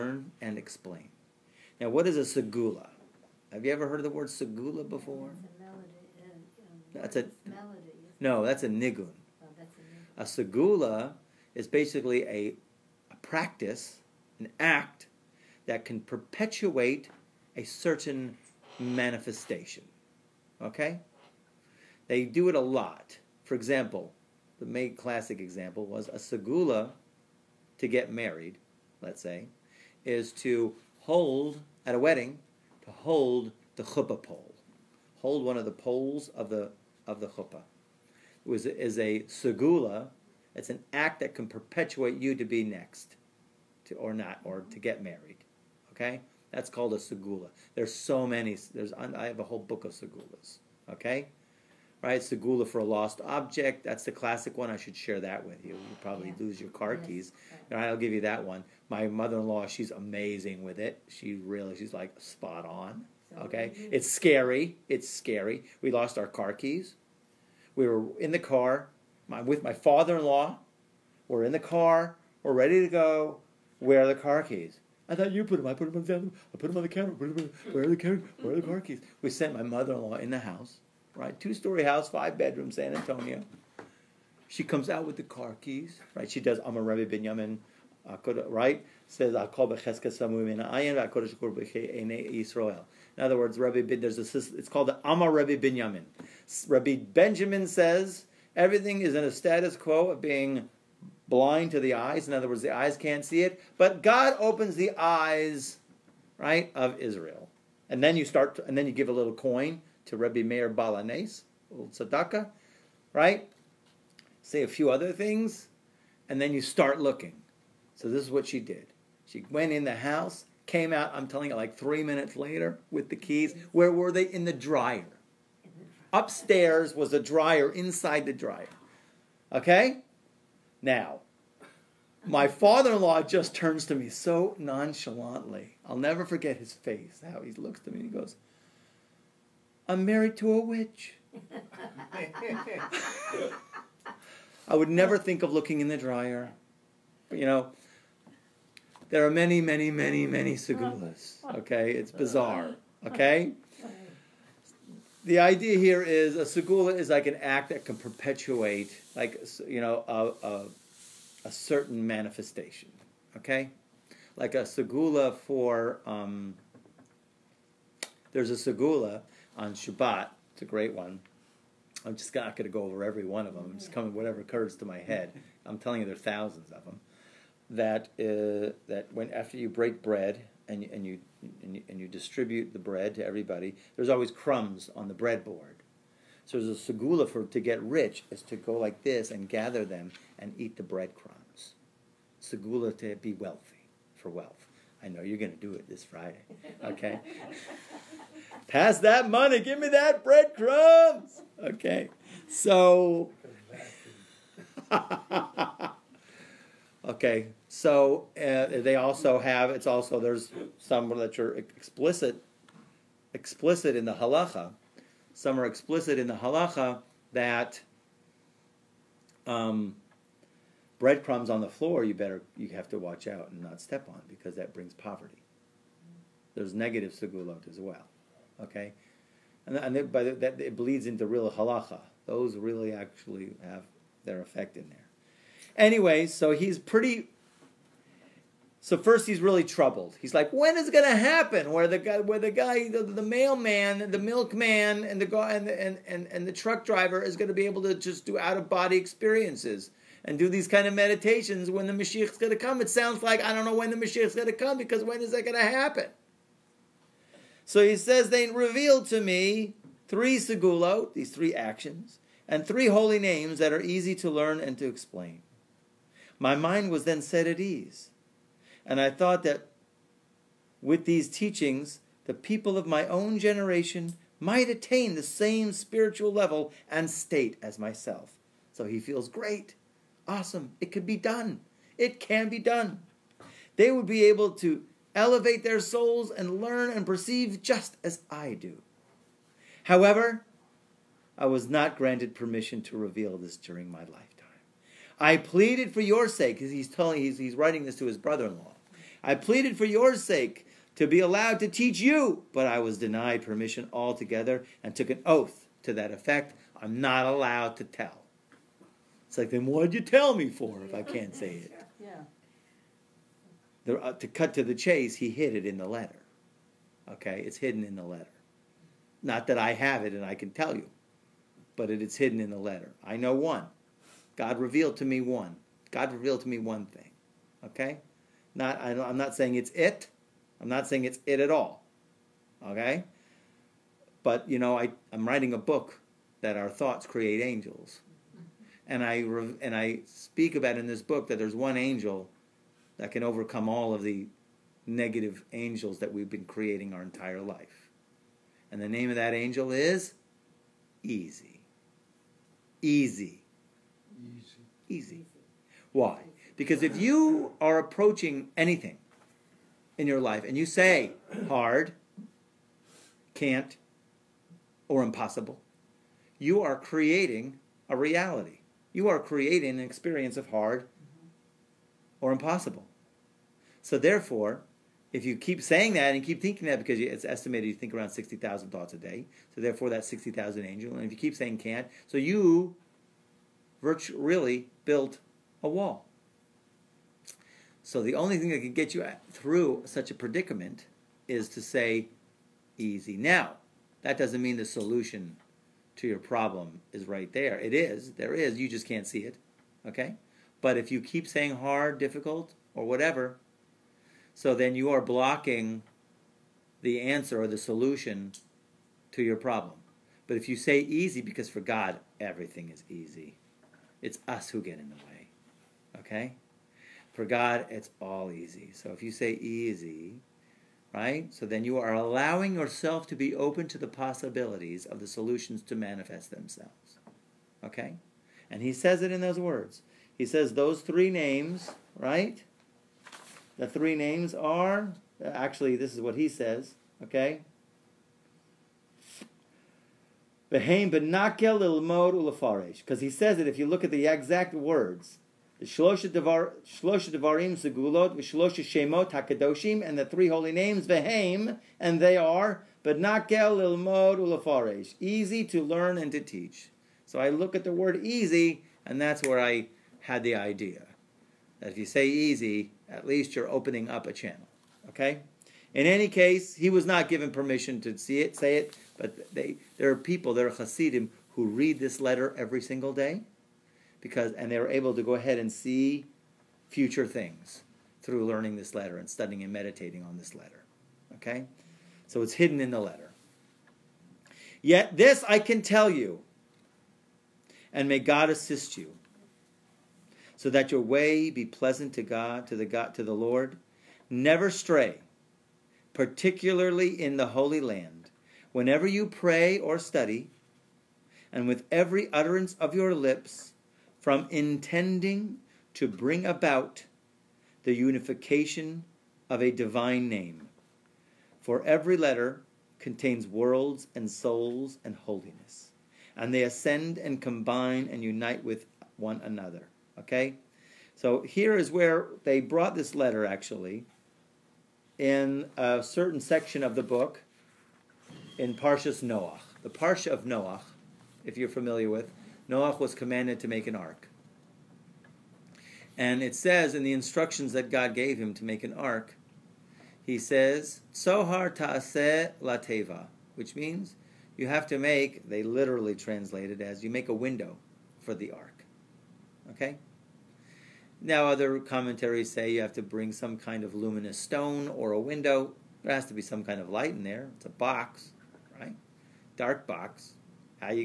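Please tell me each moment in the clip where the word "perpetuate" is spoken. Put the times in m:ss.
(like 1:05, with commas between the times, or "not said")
0:16, 0:41, 2:37.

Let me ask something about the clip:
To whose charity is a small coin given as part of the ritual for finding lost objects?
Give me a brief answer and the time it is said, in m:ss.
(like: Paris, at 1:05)
Rebbe Meir Baal HaNes, at 1:50.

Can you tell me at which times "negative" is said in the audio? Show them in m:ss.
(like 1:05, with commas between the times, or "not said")
3:46, 5:44.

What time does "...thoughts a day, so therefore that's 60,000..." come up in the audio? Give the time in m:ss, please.
6:18.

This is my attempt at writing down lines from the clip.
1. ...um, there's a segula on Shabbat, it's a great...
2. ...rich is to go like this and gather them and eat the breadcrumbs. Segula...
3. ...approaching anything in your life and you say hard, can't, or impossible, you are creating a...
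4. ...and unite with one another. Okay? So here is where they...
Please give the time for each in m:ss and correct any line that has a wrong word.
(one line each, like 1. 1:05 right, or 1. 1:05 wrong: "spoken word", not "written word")
1. 2:46 right
2. 3:07 right
3. 5:57 right
4. 8:37 right.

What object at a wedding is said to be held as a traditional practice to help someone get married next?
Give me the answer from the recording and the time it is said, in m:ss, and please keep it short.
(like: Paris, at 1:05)
Chuppah pole, at 0:32.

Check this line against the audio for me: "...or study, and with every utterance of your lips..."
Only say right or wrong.
right.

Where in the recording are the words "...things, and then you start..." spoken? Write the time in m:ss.
1:55.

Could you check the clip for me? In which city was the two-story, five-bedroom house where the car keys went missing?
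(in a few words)
San Antonio.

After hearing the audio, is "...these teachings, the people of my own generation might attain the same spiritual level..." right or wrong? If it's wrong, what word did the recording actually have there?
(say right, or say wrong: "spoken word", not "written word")
right.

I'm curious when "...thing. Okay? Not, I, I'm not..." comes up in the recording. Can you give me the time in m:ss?
5:26.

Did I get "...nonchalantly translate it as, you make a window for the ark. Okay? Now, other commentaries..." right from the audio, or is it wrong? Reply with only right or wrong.
wrong.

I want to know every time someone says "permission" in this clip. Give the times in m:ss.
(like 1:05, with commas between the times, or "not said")
4:52, 5:03, 7:47.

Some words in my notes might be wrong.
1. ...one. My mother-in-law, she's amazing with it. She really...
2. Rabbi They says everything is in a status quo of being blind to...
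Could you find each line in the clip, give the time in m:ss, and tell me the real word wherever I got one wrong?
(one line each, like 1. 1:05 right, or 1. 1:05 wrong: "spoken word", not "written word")
1. 0:58 right
2. 1:36 wrong: "Benjamin", not "They".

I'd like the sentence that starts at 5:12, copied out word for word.
Yeah the, uh, to cut to the chase, he hid it in the letter.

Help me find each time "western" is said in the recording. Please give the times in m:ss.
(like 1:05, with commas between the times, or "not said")
not said.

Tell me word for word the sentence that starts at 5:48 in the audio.
And the name of that angel is Easy.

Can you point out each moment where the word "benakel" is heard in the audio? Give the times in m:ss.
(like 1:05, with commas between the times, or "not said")
7:20, 7:32.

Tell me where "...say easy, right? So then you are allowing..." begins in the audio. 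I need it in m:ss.
6:59.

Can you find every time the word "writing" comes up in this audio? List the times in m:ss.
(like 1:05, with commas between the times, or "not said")
4:57, 5:35.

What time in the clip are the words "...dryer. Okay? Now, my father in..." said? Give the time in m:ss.
2:08.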